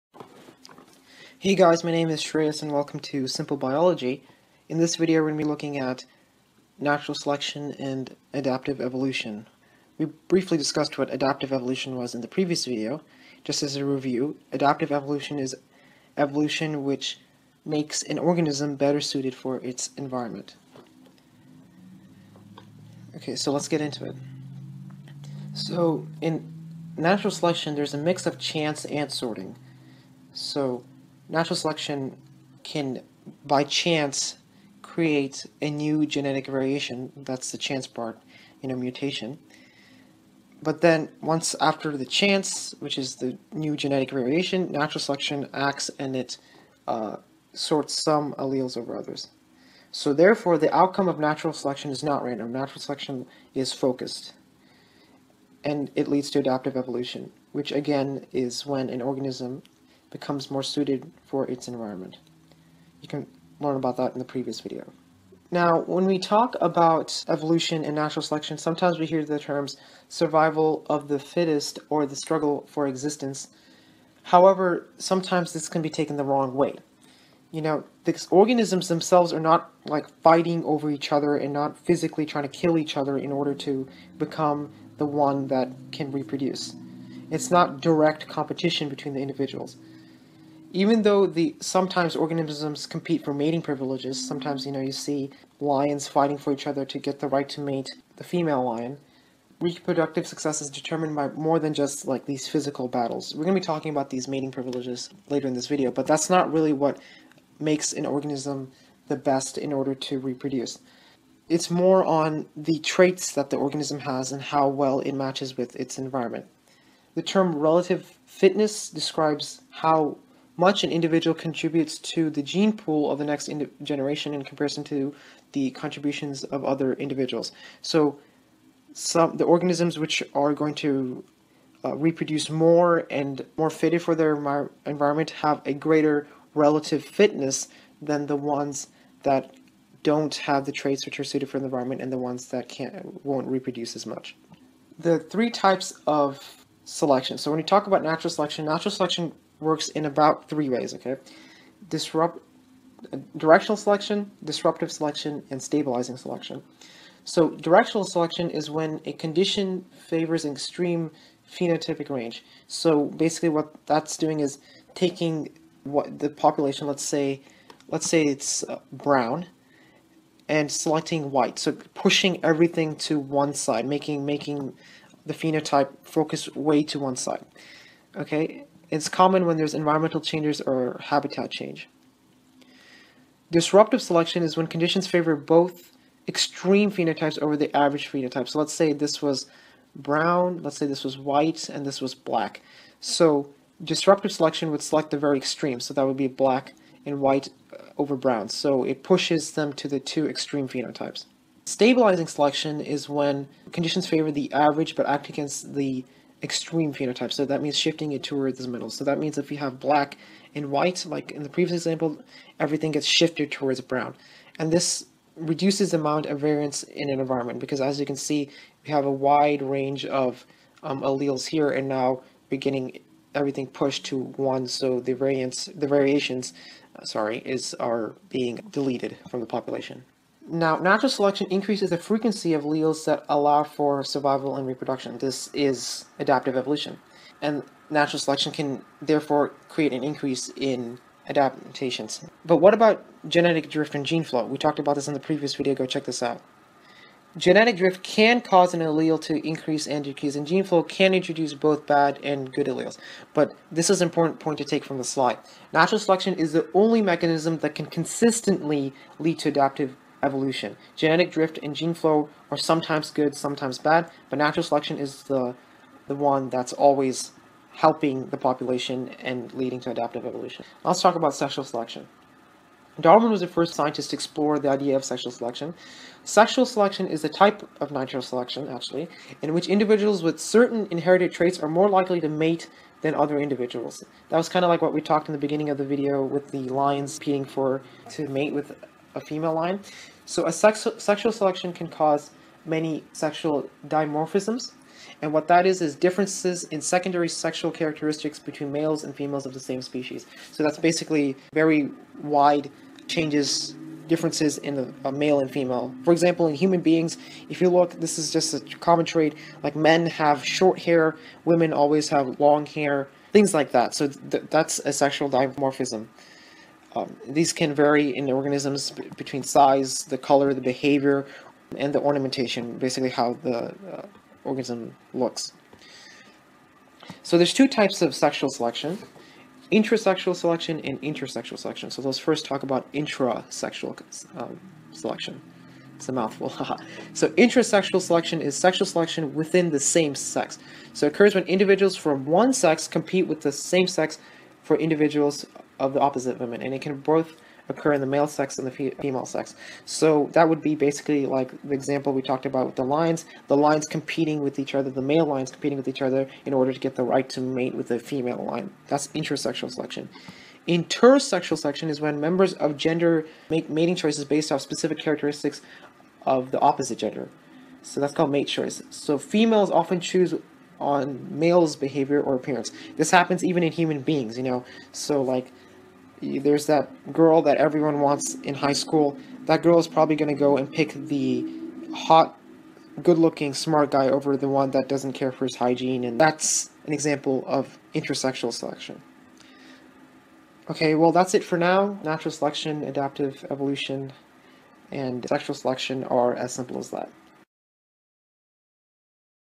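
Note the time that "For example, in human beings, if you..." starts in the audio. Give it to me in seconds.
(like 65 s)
306 s.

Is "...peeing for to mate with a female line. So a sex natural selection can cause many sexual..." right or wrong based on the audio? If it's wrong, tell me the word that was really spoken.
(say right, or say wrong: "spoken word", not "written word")
wrong: "sexual", not "natural".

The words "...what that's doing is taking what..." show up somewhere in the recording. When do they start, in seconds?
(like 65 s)
163 s.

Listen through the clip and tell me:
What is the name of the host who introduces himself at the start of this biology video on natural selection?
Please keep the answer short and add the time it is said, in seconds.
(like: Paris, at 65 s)
Shreyas, at 2 s.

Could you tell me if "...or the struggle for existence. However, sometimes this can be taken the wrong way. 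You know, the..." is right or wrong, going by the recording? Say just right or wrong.
right.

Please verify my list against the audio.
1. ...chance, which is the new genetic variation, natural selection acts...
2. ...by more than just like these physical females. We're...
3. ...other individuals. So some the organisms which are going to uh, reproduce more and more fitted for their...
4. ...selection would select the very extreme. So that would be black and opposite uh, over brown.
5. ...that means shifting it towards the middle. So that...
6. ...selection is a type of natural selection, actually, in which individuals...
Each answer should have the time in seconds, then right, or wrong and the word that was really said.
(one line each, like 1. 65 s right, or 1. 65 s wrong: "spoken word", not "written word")
1. 42 s right
2. 101 s wrong: "battles", not "females"
3. 126 s right
4. 194 s wrong: "white", not "opposite"
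5. 207 s right
6. 276 s right.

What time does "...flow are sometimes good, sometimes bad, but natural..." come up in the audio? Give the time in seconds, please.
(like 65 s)
261 s.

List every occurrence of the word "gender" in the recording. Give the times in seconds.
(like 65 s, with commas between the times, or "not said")
362 s, 366 s.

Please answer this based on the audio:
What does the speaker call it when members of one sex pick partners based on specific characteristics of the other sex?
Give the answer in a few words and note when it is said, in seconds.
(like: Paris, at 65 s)
mate choice, at 368 s.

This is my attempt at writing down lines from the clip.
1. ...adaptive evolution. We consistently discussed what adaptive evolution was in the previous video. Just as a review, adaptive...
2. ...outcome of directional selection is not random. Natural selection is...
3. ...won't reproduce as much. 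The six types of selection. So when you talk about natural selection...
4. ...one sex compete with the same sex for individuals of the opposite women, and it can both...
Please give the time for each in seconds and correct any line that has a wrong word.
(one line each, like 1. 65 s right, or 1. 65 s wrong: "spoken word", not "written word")
1. 8 s wrong: "briefly", not "consistently"
2. 50 s wrong: "natural", not "directional"
3. 143 s wrong: "three", not "six"
4. 342 s right.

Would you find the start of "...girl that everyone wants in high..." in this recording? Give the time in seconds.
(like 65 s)
377 s.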